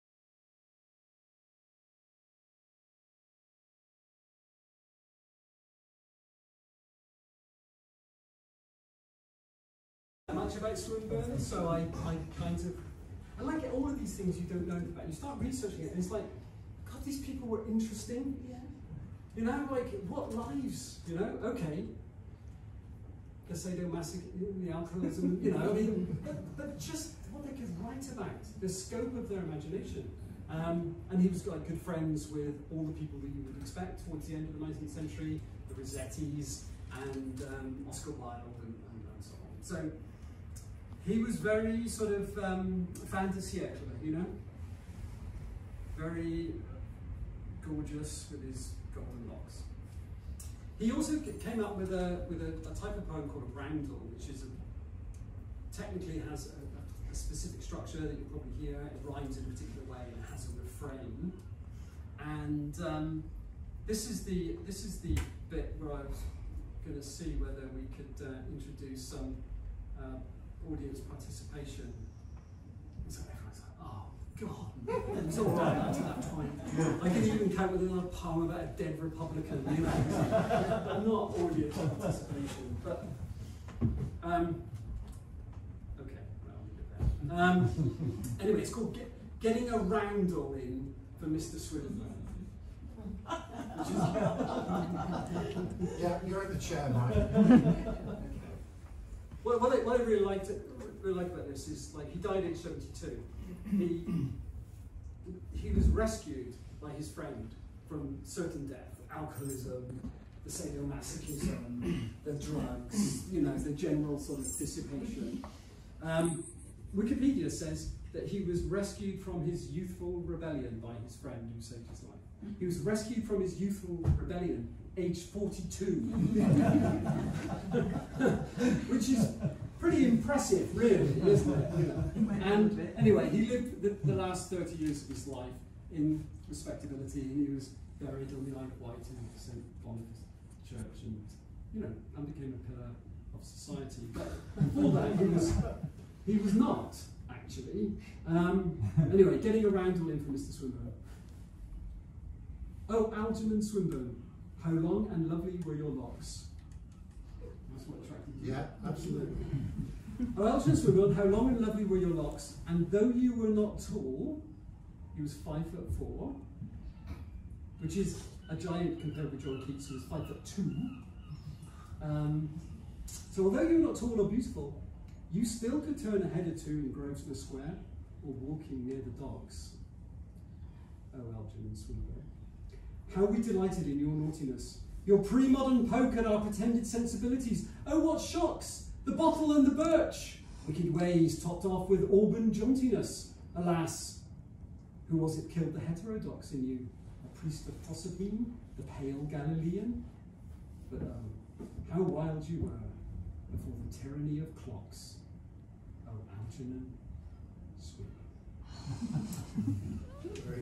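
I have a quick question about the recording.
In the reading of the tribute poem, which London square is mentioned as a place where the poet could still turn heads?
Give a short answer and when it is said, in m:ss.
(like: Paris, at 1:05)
Grosvenor Square, at 2:56.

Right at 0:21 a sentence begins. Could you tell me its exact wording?
Okay, the sadomasochism, the alcoholism, you know, I mean, but, but, just what they could write about, the scope of their imagination.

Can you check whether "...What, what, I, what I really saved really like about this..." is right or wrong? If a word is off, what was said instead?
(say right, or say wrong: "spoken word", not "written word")
wrong: "liked", not "saved".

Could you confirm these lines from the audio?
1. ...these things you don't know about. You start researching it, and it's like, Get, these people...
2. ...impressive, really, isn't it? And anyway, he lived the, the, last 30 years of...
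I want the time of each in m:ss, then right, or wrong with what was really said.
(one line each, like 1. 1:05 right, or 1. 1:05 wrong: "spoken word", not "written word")
1. 0:13 wrong: "God", not "Get"
2. 2:10 right.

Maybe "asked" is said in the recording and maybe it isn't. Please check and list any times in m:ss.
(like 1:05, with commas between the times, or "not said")
not said.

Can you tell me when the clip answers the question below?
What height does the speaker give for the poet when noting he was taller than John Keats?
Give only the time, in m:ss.
2:45.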